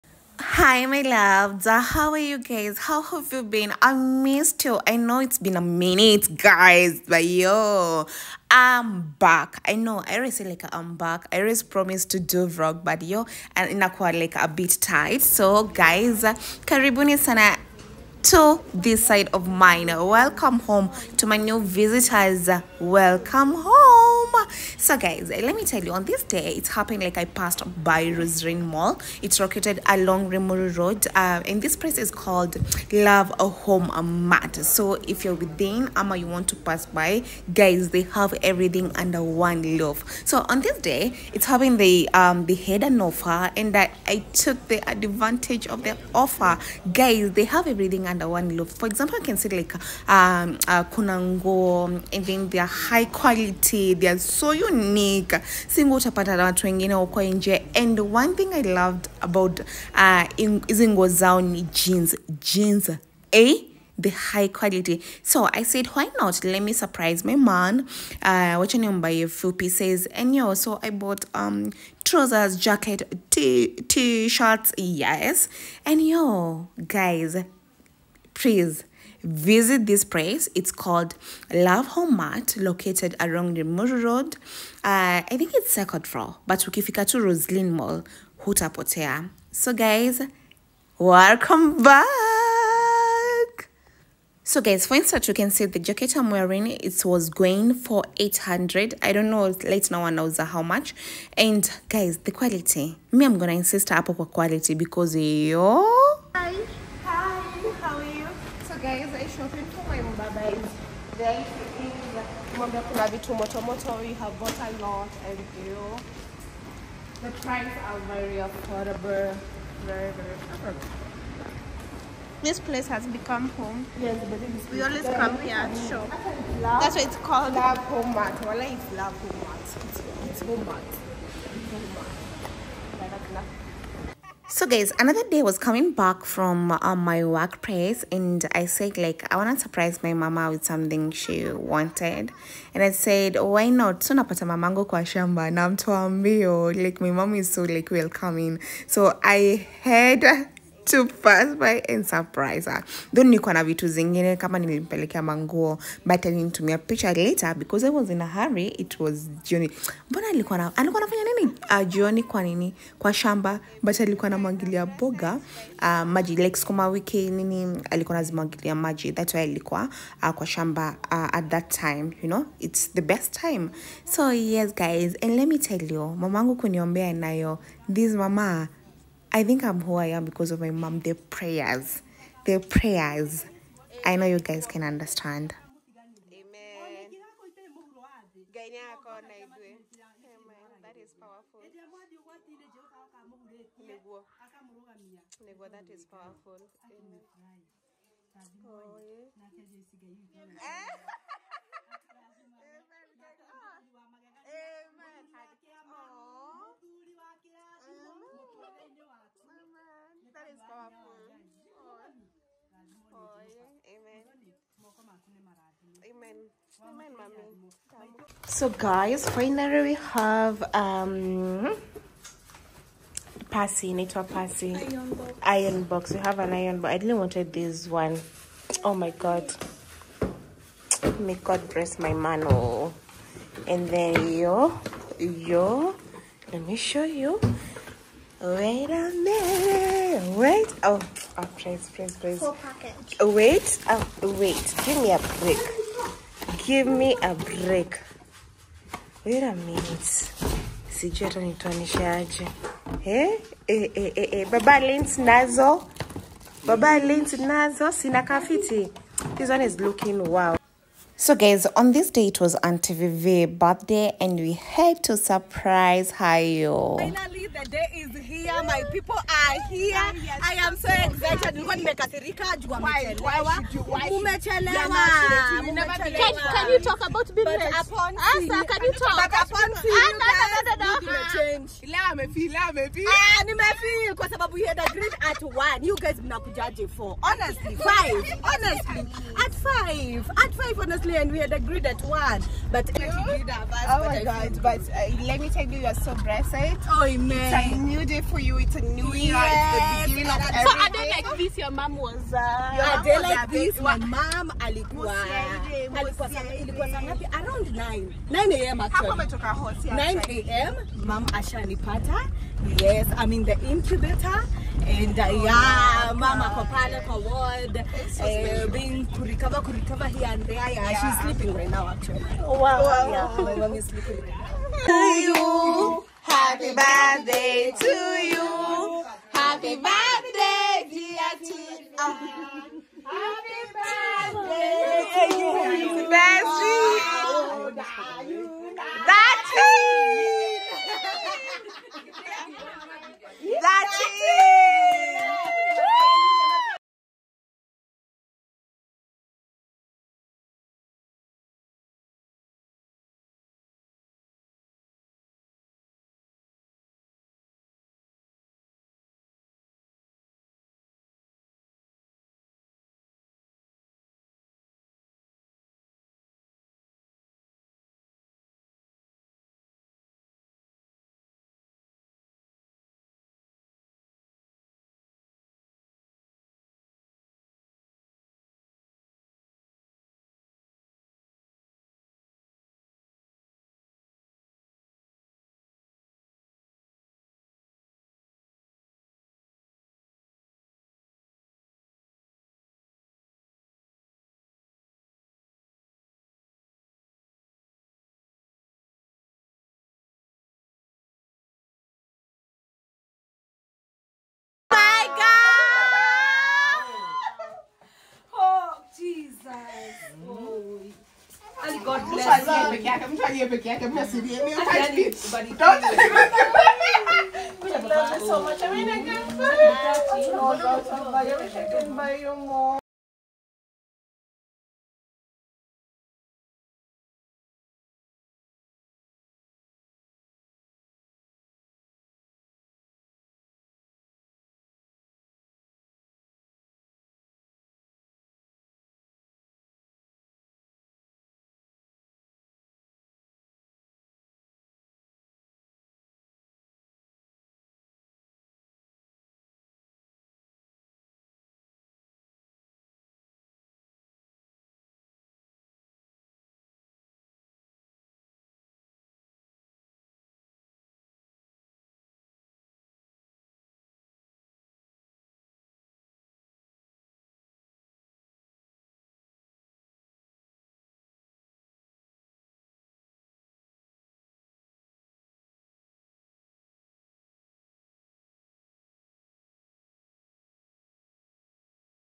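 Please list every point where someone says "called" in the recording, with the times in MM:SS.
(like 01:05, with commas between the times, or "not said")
00:32, 01:20, 02:07.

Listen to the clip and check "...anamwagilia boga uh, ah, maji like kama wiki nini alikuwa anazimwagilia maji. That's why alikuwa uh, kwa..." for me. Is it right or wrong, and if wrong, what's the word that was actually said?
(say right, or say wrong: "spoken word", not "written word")
right.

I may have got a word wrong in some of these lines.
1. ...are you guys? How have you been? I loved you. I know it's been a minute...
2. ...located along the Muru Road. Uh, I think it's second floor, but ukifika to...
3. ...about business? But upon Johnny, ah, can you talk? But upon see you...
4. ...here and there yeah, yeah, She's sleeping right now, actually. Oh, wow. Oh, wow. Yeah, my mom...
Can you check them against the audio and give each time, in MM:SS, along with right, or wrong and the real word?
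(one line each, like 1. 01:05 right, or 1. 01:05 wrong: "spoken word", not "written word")
1. 00:02 wrong: "missed", not "loved"
2. 01:22 right
3. 04:37 wrong: "Asa", not "Johnny"
4. 05:20 right.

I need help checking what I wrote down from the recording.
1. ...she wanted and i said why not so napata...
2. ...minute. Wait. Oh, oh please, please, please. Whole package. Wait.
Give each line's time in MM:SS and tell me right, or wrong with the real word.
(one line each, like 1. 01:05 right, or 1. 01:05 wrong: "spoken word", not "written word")
1. 02:21 right
2. 03:59 right.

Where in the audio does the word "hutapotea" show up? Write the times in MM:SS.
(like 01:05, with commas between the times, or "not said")
01:28.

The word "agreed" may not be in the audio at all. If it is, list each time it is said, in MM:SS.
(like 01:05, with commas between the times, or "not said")
04:44, 04:51.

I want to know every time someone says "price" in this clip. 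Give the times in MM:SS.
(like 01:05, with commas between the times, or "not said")
01:57.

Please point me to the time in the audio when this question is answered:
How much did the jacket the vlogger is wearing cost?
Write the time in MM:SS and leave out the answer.
01:38.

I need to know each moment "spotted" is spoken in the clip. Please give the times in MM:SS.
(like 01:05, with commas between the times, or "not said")
not said.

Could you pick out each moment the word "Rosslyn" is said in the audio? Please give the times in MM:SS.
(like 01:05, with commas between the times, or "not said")
00:28, 01:27.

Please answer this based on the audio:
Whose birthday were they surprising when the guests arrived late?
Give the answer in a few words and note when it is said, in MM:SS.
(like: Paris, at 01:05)
Auntie Vivi, at 04:22.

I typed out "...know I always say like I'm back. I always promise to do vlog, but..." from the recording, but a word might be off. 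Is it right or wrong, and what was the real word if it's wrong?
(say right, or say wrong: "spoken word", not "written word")
right.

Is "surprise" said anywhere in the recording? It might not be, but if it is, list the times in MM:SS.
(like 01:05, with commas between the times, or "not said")
01:06, 02:19, 02:32, 04:25.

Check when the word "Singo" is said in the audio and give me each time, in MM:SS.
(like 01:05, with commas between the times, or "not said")
00:55.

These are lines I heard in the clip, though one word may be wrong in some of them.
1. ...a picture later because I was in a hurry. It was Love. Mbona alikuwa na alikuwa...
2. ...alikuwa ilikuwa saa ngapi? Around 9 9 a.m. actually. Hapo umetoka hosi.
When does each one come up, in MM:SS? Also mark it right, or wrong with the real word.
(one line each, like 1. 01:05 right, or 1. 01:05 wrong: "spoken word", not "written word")
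1. 02:36 wrong: "Johnny", not "Love"
2. 05:05 right.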